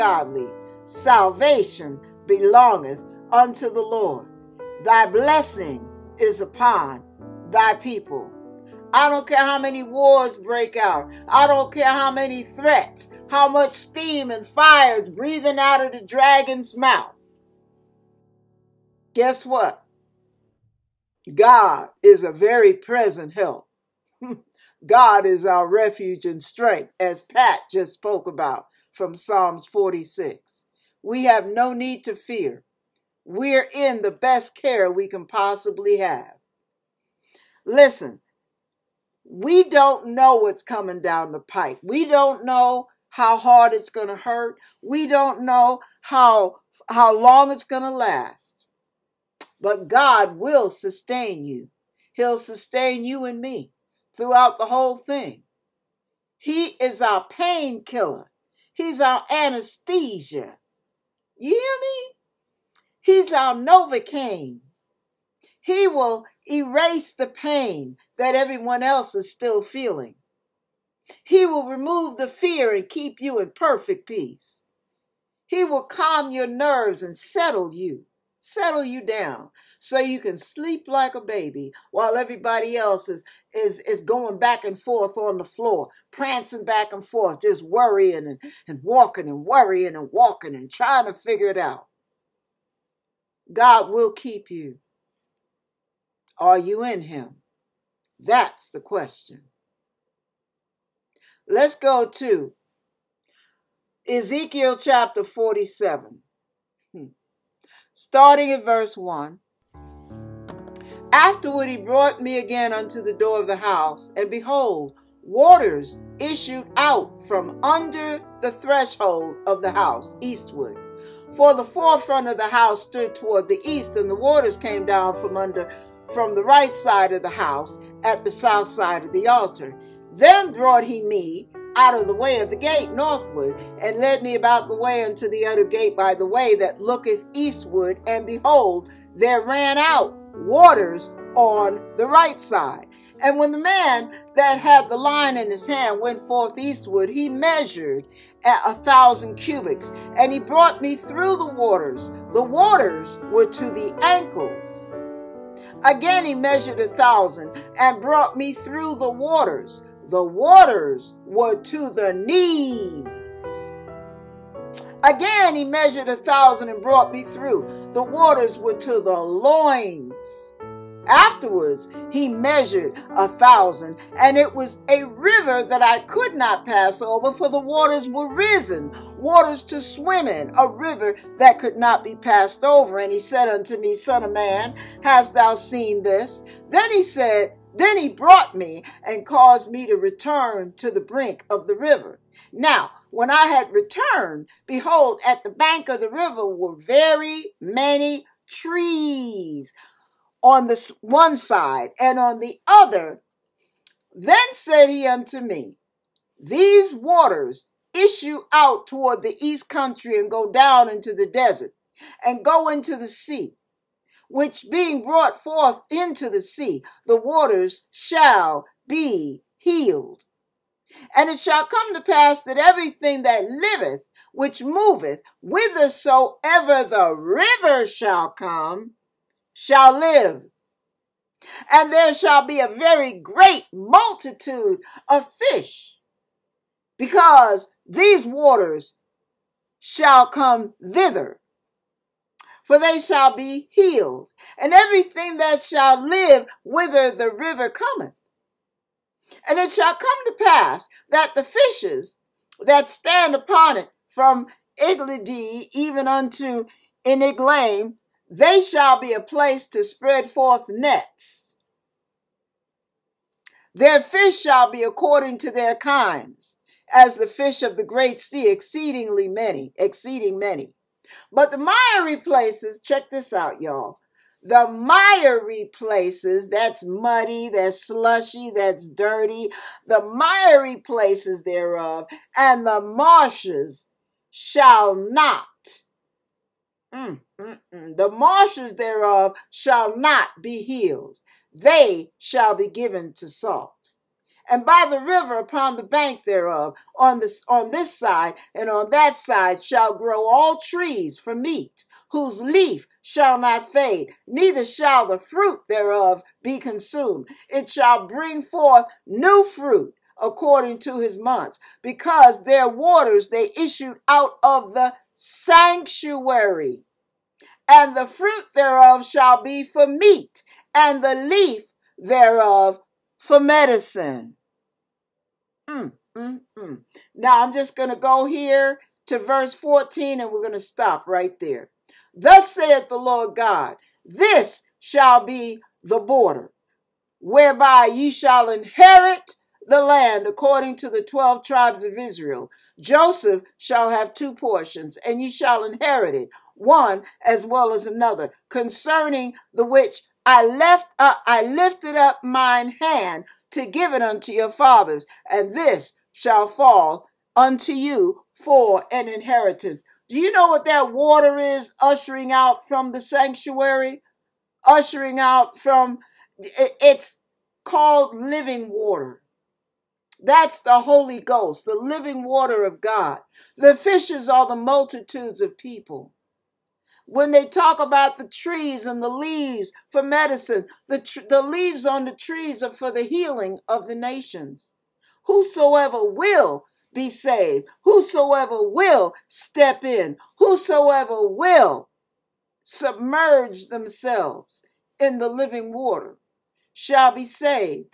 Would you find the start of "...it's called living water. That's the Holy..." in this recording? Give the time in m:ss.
6:06.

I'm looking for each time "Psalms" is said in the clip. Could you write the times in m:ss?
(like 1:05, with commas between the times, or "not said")
0:29.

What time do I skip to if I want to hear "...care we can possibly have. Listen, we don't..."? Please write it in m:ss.
0:34.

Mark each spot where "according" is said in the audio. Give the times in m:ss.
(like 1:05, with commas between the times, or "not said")
4:24, 5:10, 5:40.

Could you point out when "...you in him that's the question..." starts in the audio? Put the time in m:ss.
1:36.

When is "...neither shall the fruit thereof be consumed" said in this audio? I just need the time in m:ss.
5:04.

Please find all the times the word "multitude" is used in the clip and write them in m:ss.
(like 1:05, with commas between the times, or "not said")
3:53, 6:14.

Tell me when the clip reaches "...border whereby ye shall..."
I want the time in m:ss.
5:35.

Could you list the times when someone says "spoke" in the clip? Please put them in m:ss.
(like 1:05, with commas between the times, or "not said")
0:27.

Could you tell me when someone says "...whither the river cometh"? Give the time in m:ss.
4:06.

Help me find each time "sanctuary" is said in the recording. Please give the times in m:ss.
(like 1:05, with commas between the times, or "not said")
5:15, 6:02.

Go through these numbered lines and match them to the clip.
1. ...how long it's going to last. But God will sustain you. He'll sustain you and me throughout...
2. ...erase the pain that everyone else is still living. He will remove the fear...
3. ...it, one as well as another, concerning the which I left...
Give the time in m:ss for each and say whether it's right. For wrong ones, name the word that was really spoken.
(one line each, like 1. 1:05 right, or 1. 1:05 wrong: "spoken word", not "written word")
1. 0:46 right
2. 1:06 wrong: "feeling", not "living"
3. 5:46 right.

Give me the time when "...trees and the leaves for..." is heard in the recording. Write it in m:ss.
6:18.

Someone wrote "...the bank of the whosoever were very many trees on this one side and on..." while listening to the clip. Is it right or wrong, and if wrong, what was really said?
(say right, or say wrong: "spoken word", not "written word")
wrong: "river", not "whosoever".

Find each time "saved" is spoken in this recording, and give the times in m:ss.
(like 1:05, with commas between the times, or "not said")
6:27, 6:37.